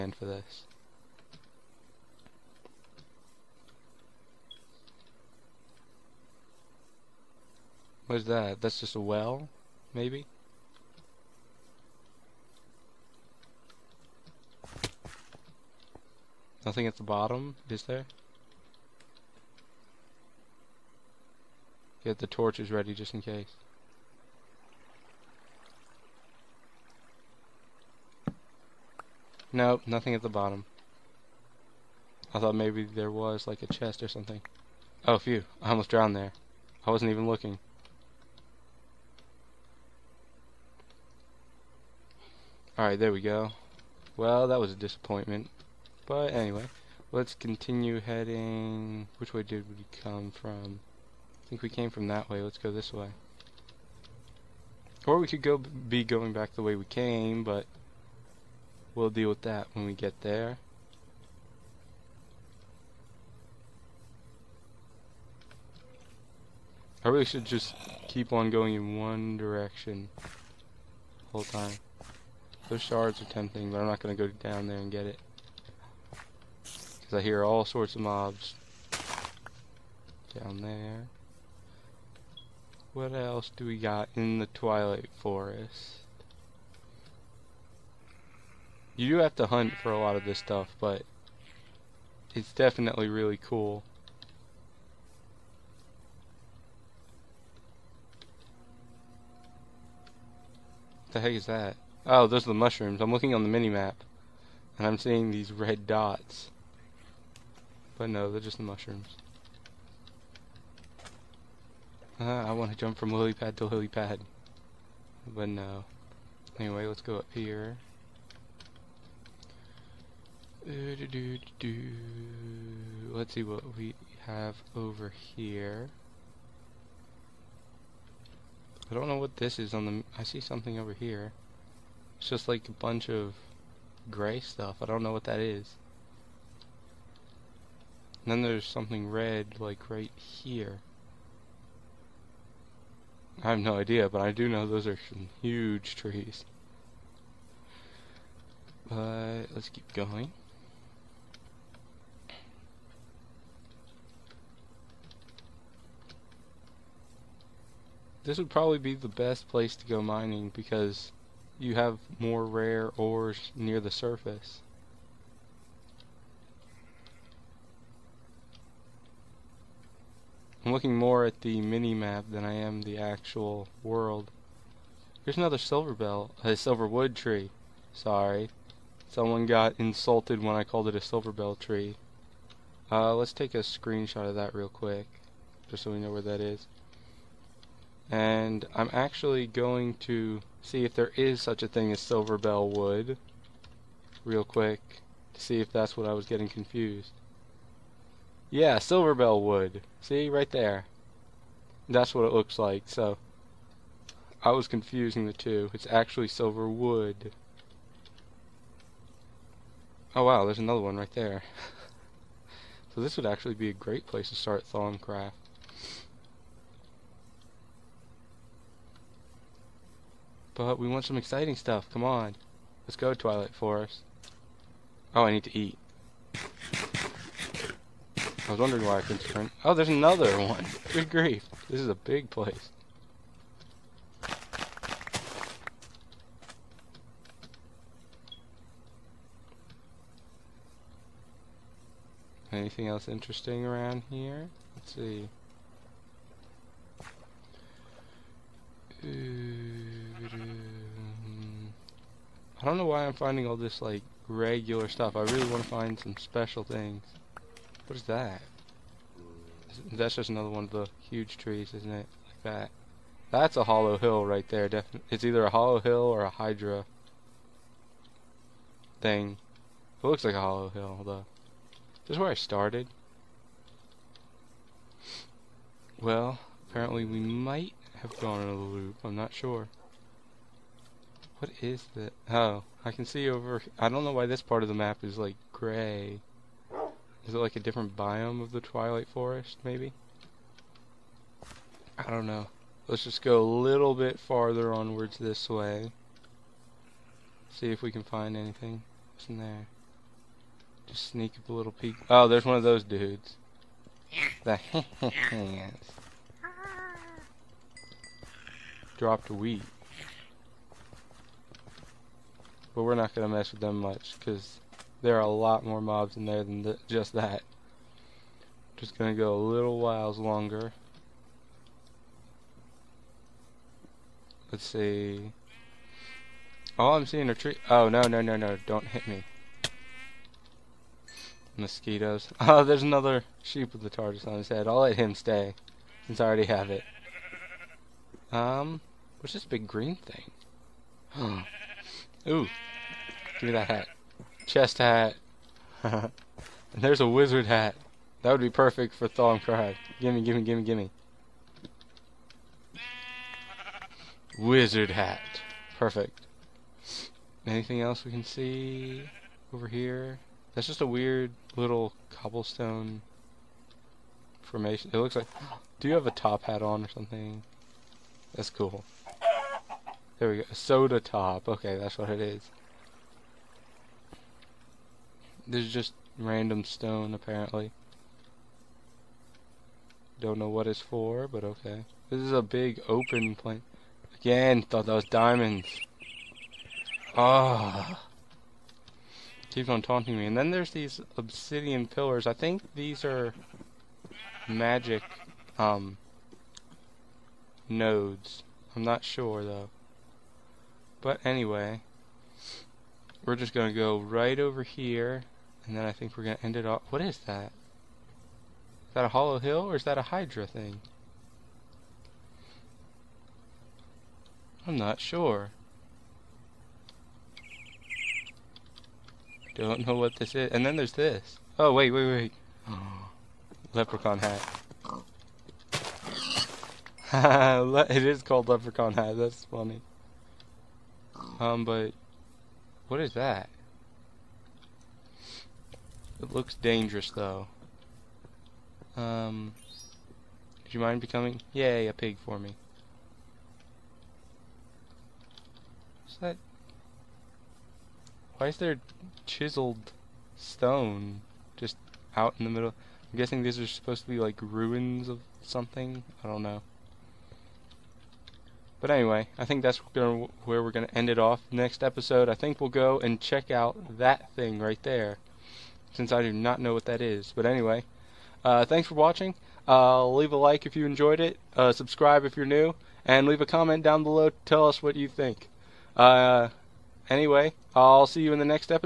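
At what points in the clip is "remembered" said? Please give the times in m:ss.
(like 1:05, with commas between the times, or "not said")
not said.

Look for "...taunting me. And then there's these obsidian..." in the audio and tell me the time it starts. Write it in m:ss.
6:29.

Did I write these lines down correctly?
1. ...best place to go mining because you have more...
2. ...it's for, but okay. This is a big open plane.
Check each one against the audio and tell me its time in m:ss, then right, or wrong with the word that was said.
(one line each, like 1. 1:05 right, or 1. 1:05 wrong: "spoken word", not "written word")
1. 2:39 right
2. 6:20 right.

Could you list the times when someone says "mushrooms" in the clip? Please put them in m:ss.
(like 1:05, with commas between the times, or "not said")
1:42, 1:48.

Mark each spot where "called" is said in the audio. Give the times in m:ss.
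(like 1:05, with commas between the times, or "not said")
3:00, 7:08.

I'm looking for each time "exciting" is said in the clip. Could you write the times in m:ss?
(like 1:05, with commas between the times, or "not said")
3:41.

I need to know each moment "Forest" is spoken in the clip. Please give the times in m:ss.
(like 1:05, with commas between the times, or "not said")
1:25, 3:43, 4:49.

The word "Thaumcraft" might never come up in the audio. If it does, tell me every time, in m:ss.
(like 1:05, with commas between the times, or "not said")
3:34, 5:49.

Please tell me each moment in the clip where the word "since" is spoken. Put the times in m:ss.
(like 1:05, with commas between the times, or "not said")
5:36, 7:45.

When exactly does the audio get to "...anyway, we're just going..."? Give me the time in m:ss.
6:41.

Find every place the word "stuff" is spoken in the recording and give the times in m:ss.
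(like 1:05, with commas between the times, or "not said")
1:30, 2:14, 3:41, 4:14.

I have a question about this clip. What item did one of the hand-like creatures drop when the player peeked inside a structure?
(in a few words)
Wheat.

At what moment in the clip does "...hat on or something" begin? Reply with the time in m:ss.
6:06.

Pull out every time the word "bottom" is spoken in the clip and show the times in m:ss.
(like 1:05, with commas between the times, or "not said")
0:17, 0:30.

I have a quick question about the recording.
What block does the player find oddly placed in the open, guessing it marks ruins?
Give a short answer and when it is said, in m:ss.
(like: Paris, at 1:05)
Chiseled stone, at 7:29.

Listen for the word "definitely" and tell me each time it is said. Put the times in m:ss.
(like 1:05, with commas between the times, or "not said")
1:32, 4:24.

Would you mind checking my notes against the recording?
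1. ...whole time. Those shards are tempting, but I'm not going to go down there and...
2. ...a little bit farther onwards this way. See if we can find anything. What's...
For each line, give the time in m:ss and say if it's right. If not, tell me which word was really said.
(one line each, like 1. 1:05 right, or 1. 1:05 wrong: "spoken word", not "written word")
1. 1:11 right
2. 4:53 right.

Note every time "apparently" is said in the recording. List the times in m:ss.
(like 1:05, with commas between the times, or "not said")
4:36, 6:17.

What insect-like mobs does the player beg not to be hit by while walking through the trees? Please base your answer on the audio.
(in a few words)
Mosquitoes.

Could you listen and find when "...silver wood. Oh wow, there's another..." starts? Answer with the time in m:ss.
3:26.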